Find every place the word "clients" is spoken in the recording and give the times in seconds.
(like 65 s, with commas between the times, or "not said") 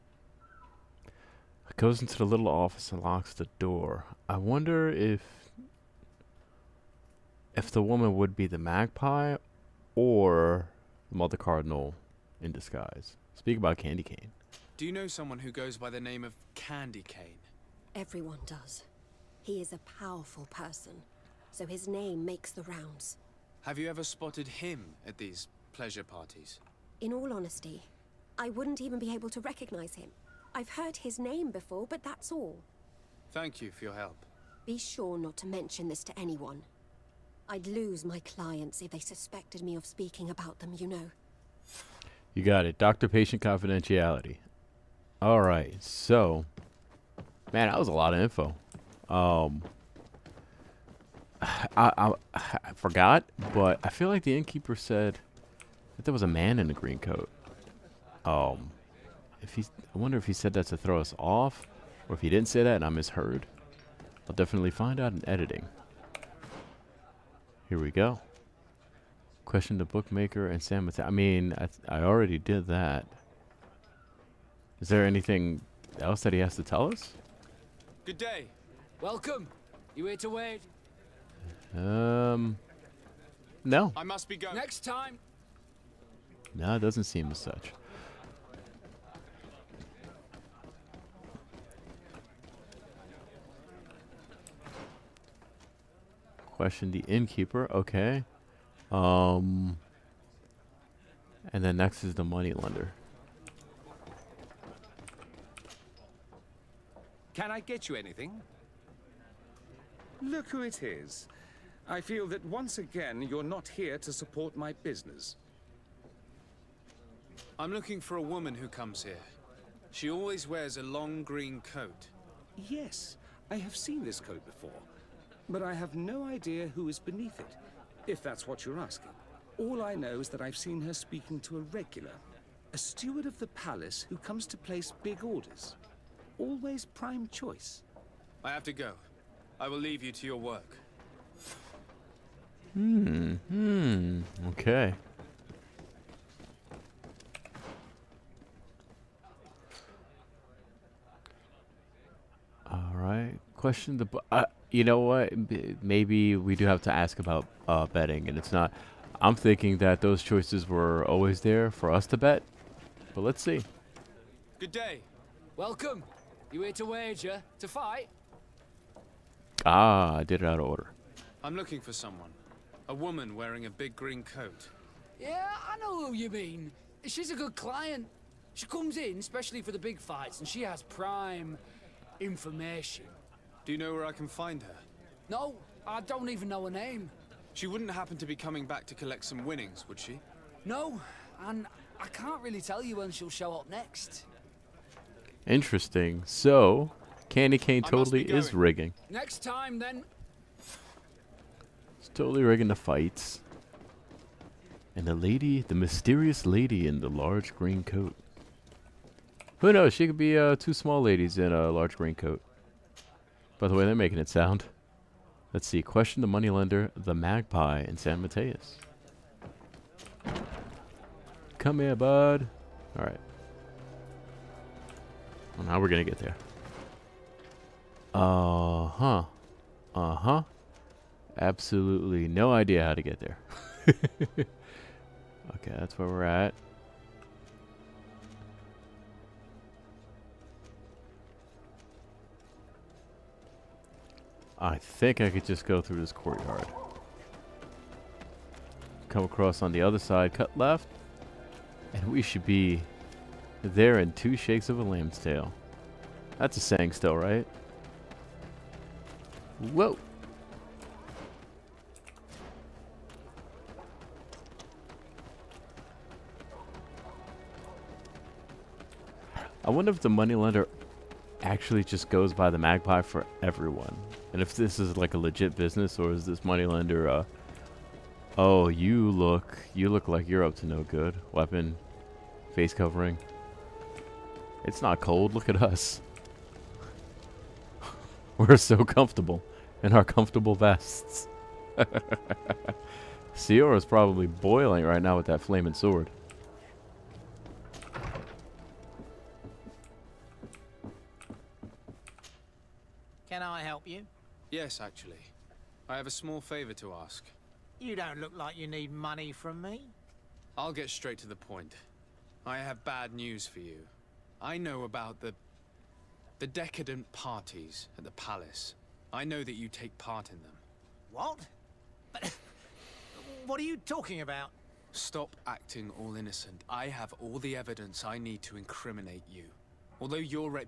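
38 s, 177 s.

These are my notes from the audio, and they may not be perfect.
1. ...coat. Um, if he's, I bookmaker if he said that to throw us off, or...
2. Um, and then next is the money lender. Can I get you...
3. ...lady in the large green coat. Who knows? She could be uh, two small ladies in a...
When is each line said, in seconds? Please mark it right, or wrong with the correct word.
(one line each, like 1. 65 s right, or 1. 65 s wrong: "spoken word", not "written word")
1. 56 s wrong: "wonder", not "bookmaker"
2. 98 s right
3. 206 s right.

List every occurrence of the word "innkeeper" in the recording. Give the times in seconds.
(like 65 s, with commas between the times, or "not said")
54 s, 97 s.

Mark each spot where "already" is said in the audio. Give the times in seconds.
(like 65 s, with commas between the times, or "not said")
72 s.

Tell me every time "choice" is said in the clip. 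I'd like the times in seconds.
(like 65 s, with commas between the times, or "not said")
137 s, 160 s.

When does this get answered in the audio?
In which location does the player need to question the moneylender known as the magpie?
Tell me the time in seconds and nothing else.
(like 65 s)
217 s.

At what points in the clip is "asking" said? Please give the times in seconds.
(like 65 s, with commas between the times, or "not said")
128 s.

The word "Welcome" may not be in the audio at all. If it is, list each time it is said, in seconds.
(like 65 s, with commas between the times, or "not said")
79 s, 165 s.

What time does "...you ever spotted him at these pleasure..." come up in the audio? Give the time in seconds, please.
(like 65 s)
23 s.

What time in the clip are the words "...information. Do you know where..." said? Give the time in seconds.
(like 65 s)
182 s.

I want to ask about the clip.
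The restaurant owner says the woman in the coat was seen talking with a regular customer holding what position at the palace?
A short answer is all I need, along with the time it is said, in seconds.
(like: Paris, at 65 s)
steward, at 132 s.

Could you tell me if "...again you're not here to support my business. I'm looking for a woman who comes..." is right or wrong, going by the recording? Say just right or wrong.
right.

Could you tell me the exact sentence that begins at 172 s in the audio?
A woman wearing a big green coat.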